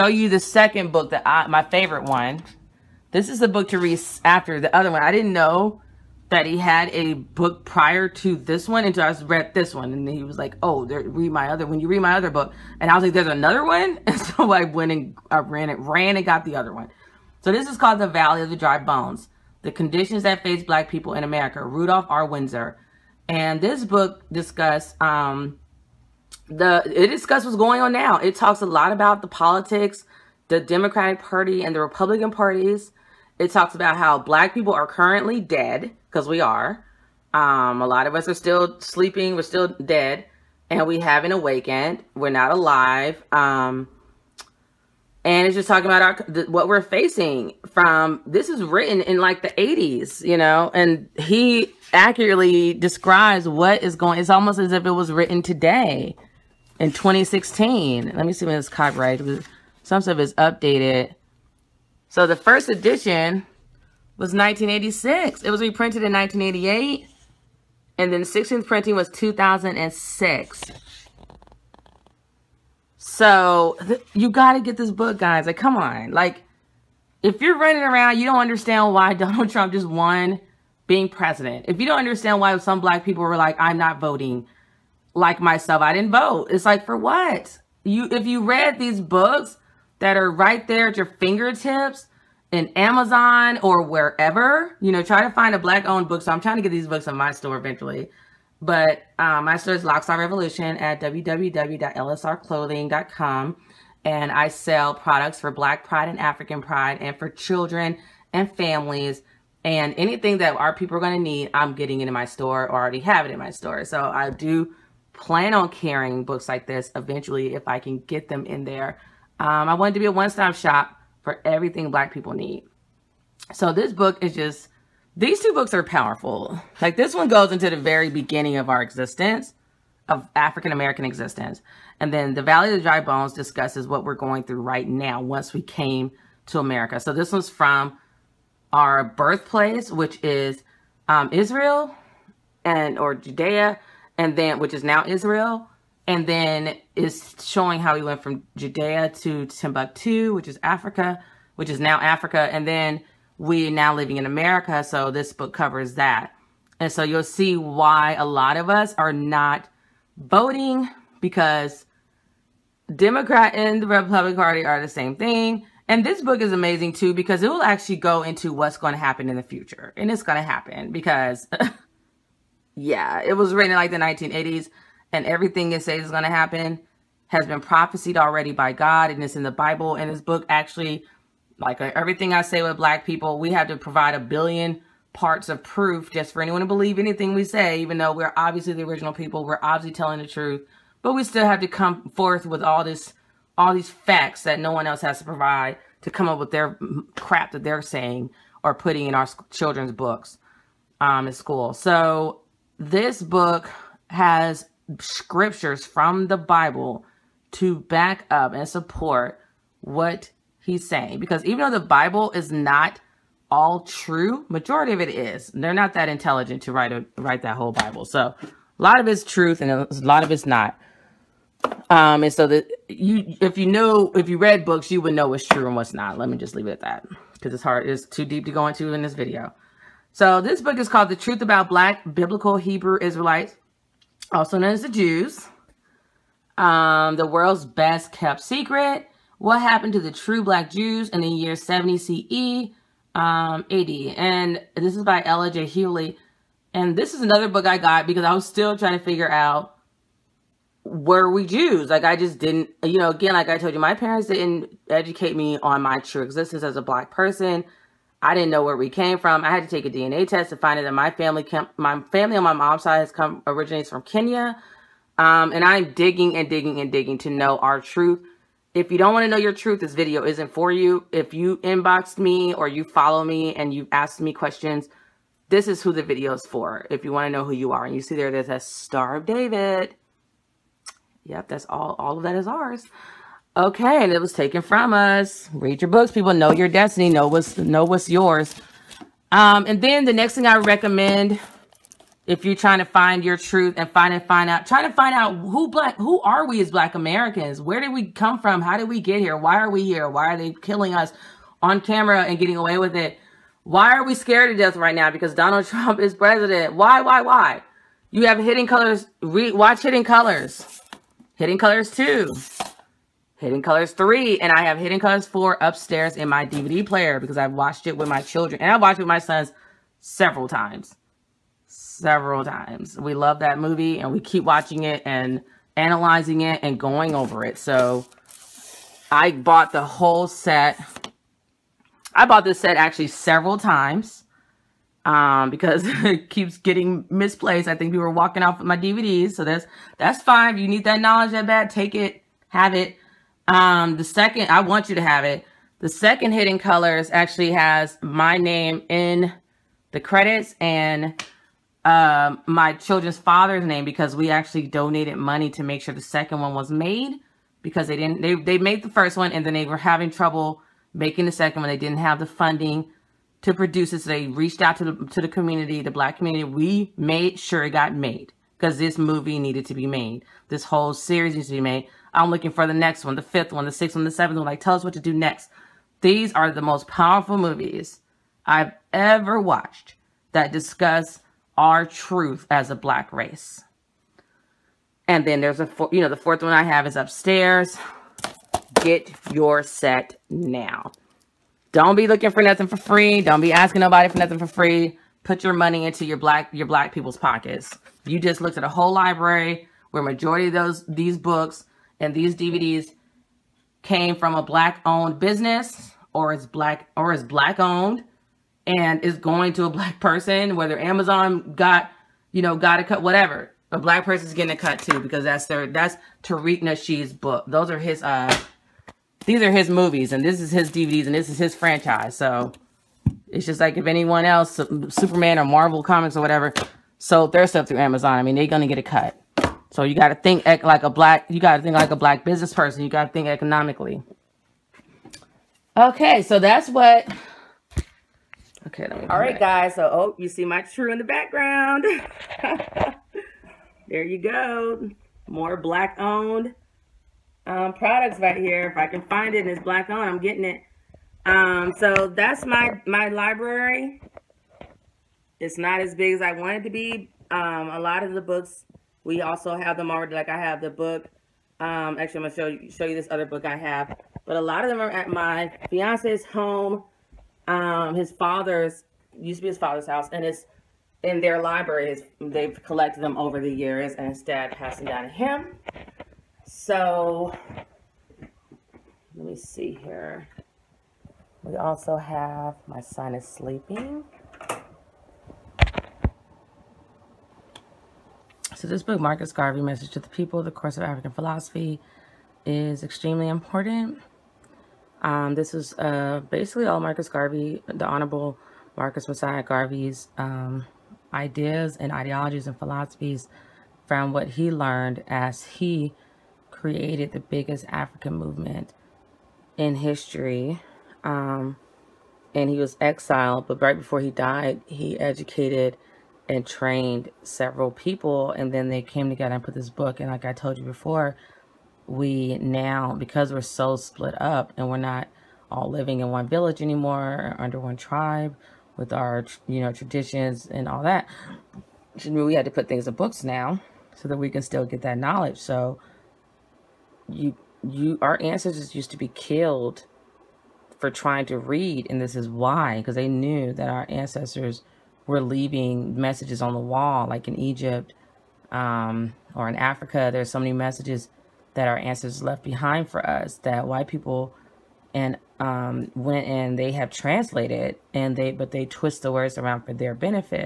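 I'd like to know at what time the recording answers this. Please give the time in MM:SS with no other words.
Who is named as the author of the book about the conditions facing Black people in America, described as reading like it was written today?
00:21.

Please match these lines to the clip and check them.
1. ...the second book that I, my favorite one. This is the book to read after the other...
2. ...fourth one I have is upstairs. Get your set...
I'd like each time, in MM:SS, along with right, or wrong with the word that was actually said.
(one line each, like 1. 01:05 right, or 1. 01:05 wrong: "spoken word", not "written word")
1. 00:00 right
2. 06:26 right.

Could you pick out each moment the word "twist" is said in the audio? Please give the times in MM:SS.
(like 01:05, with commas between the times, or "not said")
09:18.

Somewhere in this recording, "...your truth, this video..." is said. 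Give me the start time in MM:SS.
04:29.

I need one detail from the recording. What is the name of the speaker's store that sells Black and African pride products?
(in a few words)
LocStar Revolution.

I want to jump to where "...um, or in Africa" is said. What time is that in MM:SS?
09:08.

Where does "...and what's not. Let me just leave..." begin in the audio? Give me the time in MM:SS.
03:45.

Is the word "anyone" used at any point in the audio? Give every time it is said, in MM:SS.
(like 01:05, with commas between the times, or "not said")
03:06, 07:03.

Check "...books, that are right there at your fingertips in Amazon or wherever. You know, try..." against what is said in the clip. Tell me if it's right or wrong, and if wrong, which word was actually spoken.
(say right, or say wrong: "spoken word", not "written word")
right.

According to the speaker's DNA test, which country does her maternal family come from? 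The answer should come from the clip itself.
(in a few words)
Kenya.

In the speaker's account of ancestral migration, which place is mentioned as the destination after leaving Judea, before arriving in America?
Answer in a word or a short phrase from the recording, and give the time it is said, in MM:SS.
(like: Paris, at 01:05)
Timbuktu, at 02:29.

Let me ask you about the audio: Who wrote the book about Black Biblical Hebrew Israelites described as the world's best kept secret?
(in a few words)
Ella J. Hughley.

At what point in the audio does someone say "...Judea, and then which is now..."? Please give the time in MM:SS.
02:23.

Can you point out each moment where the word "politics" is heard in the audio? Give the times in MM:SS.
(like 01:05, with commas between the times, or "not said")
00:29.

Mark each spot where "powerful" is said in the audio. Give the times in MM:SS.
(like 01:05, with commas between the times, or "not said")
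02:05, 06:16.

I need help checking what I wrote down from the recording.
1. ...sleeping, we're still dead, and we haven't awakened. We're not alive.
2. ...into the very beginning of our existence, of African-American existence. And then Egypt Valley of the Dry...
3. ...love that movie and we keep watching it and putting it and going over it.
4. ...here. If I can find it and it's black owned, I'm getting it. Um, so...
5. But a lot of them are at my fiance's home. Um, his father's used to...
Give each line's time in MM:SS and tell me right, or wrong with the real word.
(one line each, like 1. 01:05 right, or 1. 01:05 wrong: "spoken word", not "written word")
1. 00:38 right
2. 02:07 wrong: "The", not "Egypt"
3. 05:23 wrong: "analyzing", not "putting"
4. 07:28 right
5. 07:44 right.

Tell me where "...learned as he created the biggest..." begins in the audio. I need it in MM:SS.
08:24.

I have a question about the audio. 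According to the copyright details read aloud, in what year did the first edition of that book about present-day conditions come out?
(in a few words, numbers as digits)
1986.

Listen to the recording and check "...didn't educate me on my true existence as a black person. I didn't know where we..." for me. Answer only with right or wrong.
right.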